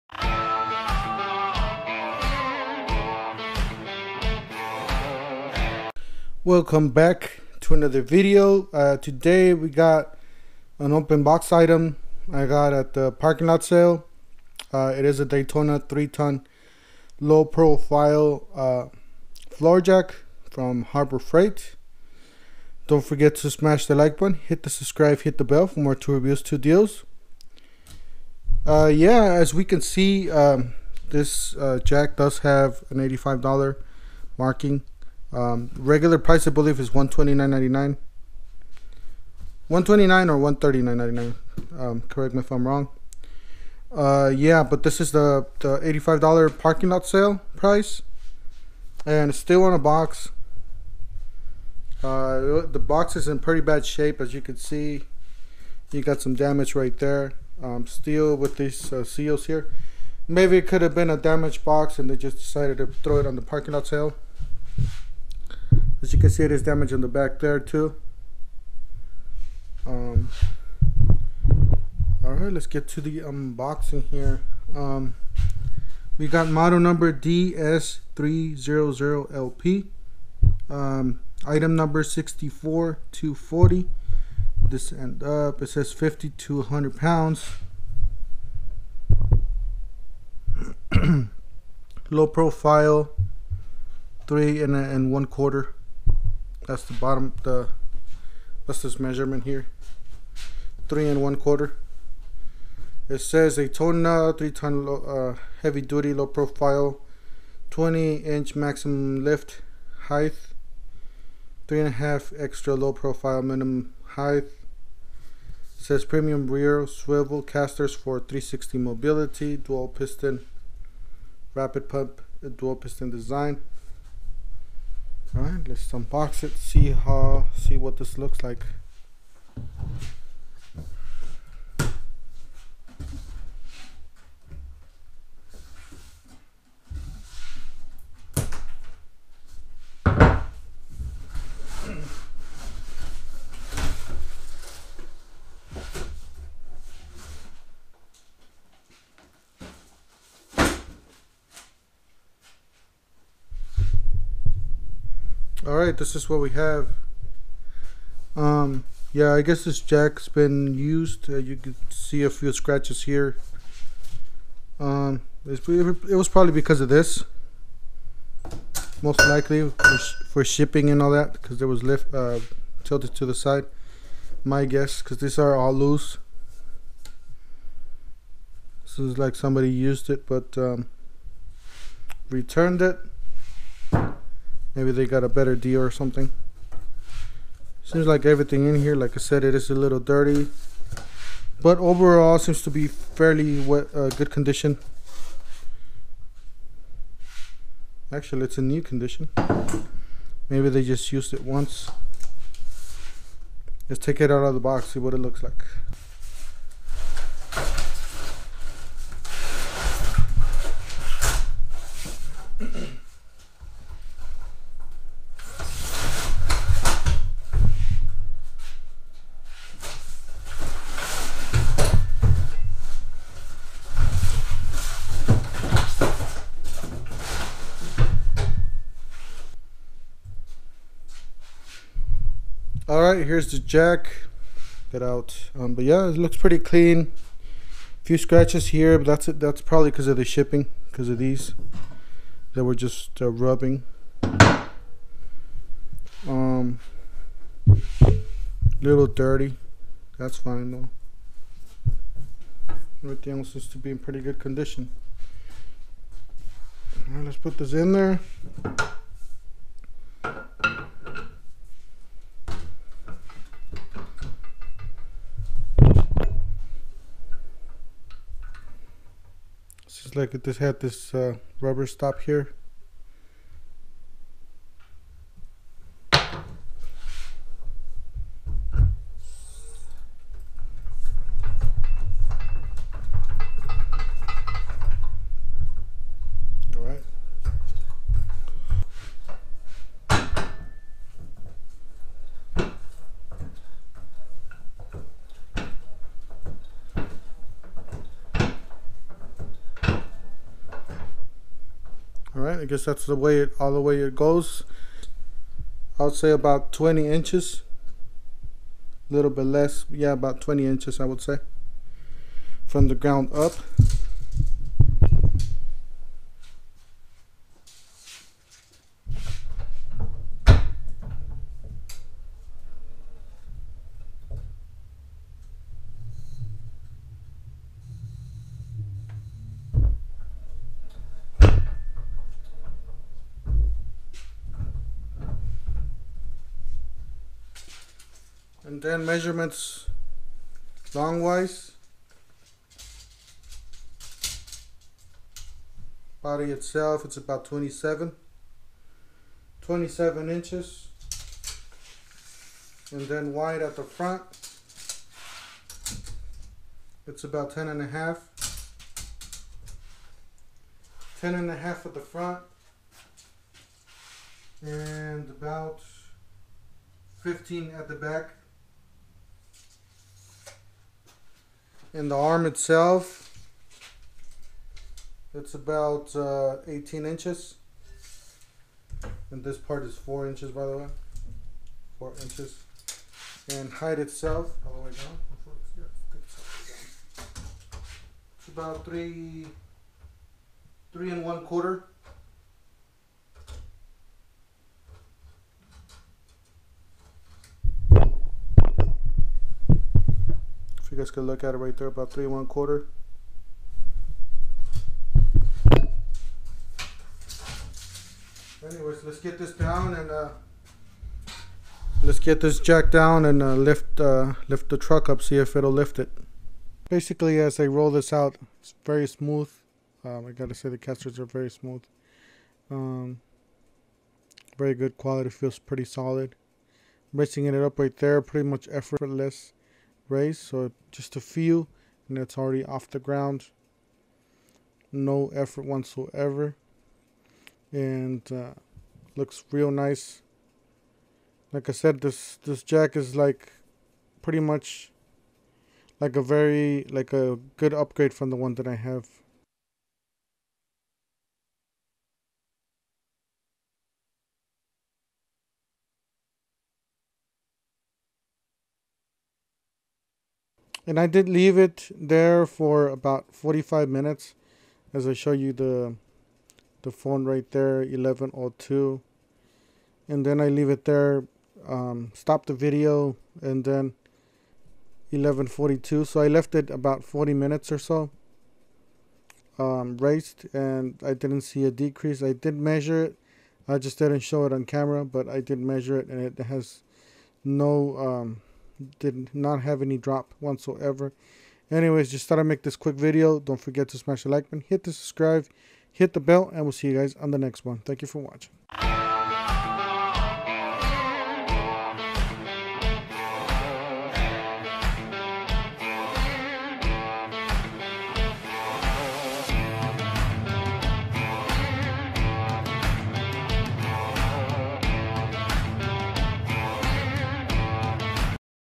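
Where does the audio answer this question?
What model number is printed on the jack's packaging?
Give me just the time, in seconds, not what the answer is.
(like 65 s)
77 s.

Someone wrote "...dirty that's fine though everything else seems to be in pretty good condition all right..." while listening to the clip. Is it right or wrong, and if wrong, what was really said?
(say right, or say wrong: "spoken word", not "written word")
right.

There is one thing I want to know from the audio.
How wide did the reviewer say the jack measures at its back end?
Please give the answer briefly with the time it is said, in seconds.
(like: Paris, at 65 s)
15 inches, at 365 s.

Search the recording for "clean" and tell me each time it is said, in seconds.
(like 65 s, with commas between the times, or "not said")
236 s.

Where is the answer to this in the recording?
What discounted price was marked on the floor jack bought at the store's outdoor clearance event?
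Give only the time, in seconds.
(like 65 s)
32 s.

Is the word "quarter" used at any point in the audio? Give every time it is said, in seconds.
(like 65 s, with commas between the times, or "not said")
95 s, 101 s, 391 s, 402 s.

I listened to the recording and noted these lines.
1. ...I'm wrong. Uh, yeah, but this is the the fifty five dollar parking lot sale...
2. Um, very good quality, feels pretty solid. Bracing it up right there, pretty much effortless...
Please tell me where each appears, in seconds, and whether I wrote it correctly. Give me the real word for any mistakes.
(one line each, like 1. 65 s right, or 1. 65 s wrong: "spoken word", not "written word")
1. 42 s wrong: "eighty", not "fifty"
2. 422 s right.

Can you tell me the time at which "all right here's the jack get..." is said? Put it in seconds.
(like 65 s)
232 s.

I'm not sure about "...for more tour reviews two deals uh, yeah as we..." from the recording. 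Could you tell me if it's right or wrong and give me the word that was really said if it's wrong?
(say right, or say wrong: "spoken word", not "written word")
right.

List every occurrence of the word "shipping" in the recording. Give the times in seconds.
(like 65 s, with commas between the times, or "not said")
170 s, 240 s.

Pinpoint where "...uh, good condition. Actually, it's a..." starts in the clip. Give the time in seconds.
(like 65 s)
193 s.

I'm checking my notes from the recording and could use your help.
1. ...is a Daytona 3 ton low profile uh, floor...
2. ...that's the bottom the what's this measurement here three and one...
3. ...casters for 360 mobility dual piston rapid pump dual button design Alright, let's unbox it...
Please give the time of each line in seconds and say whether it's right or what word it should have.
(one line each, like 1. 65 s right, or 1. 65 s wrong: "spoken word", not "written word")
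1. 15 s right
2. 96 s right
3. 117 s wrong: "piston", not "button".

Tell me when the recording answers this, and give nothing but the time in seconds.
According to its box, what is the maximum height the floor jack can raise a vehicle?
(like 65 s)
107 s.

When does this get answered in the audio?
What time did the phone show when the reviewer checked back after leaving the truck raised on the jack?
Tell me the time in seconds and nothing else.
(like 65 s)
475 s.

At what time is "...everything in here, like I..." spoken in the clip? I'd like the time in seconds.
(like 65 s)
188 s.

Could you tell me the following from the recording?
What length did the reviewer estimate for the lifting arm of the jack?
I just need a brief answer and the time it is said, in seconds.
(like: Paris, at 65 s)
18 inches, at 376 s.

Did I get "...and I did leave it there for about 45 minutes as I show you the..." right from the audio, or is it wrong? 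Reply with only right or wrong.
right.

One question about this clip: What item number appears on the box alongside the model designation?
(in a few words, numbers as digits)
64240.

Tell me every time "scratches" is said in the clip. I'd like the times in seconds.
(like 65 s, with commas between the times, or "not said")
162 s, 238 s.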